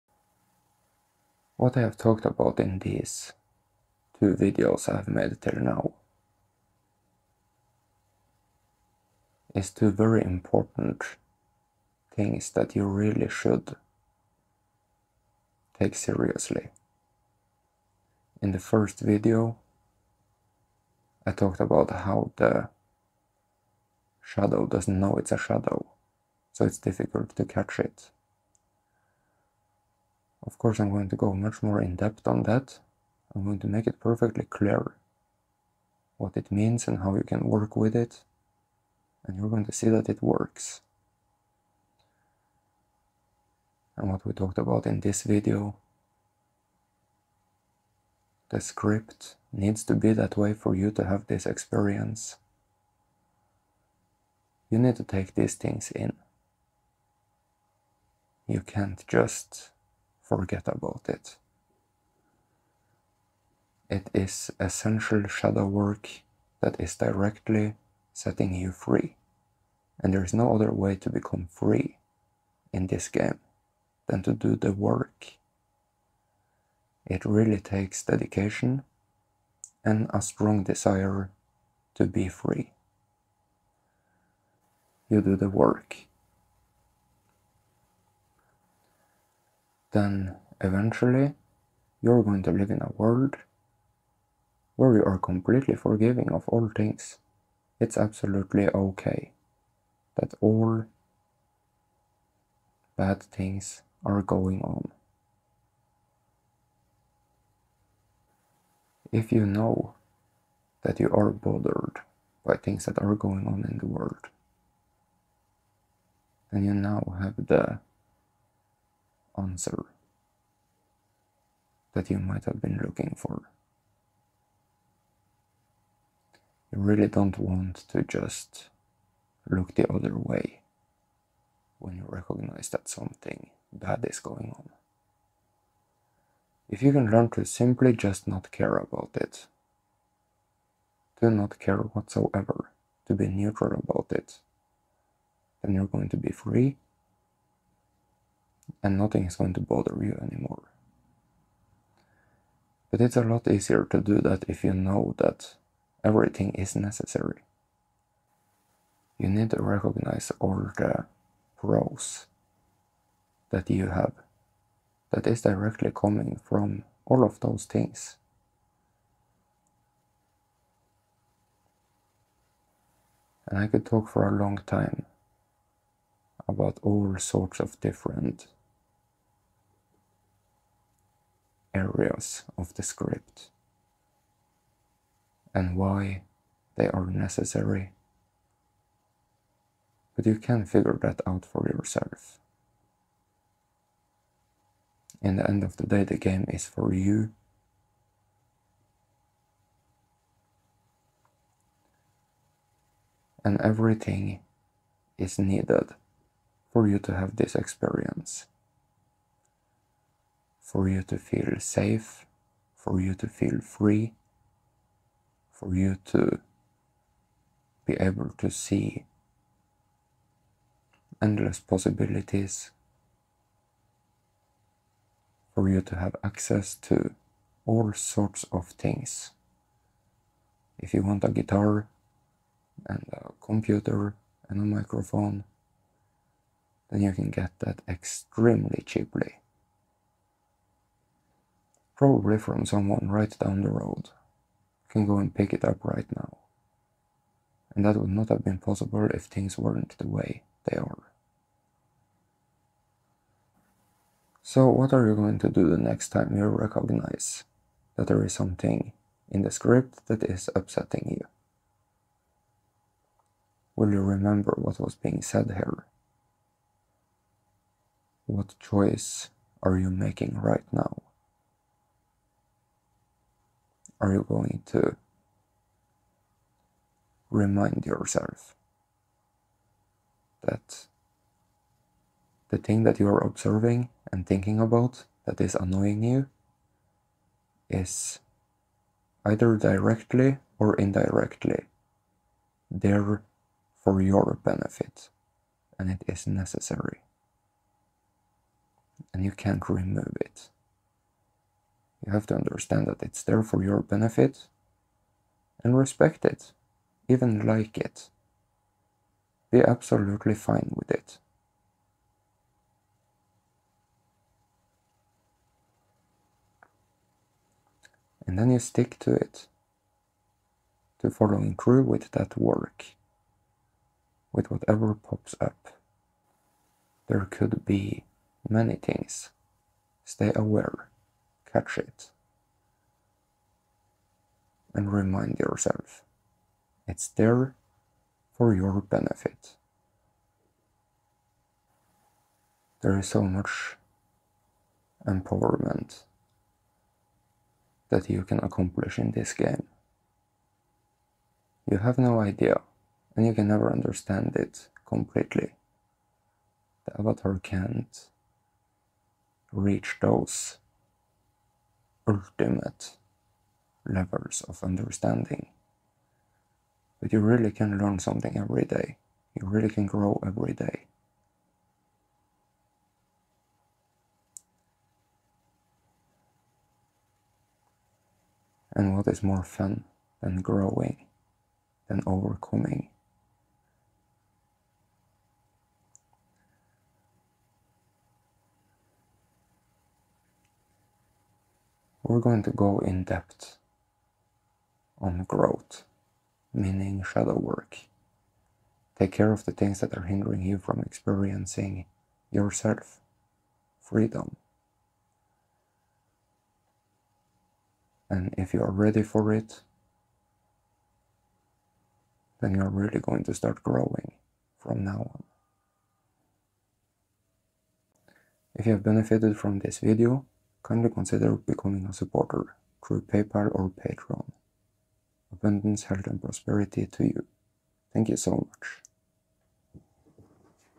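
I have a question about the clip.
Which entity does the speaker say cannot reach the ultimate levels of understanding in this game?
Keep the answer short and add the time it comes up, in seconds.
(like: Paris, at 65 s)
The avatar, at 356 s.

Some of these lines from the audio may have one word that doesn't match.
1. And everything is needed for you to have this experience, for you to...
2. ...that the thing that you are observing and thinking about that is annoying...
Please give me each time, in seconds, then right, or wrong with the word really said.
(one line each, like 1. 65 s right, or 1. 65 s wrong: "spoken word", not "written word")
1. 203 s right
2. 280 s right.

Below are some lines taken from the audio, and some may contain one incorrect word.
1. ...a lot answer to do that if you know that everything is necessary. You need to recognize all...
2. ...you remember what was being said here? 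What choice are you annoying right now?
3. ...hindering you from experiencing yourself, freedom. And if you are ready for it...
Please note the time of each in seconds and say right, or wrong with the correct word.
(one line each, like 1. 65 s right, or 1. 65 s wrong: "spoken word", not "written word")
1. 153 s wrong: "easier", not "answer"
2. 263 s wrong: "making", not "annoying"
3. 400 s right.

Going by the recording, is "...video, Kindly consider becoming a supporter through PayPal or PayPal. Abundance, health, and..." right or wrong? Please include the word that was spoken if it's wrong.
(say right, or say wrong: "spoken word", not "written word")
wrong: "Patreon", not "PayPal".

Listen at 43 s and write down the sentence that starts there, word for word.
And what we talked about in this video, the script needs to be that way for you to have this experience.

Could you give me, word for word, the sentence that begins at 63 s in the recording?
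It is essential shadow work that is directly setting you free.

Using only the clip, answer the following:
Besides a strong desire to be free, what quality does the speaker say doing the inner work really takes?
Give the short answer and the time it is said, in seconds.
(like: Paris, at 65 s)
Dedication, at 78 s.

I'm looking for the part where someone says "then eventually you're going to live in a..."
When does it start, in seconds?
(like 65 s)
89 s.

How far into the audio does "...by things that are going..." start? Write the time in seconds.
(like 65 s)
112 s.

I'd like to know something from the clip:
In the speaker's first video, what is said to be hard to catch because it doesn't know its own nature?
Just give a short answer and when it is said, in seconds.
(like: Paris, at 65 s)
The shadow, at 22 s.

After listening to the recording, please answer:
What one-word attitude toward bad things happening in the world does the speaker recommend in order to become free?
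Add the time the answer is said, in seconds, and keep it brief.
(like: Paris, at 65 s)
Neutral, at 143 s.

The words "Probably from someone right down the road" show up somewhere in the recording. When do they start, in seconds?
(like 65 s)
241 s.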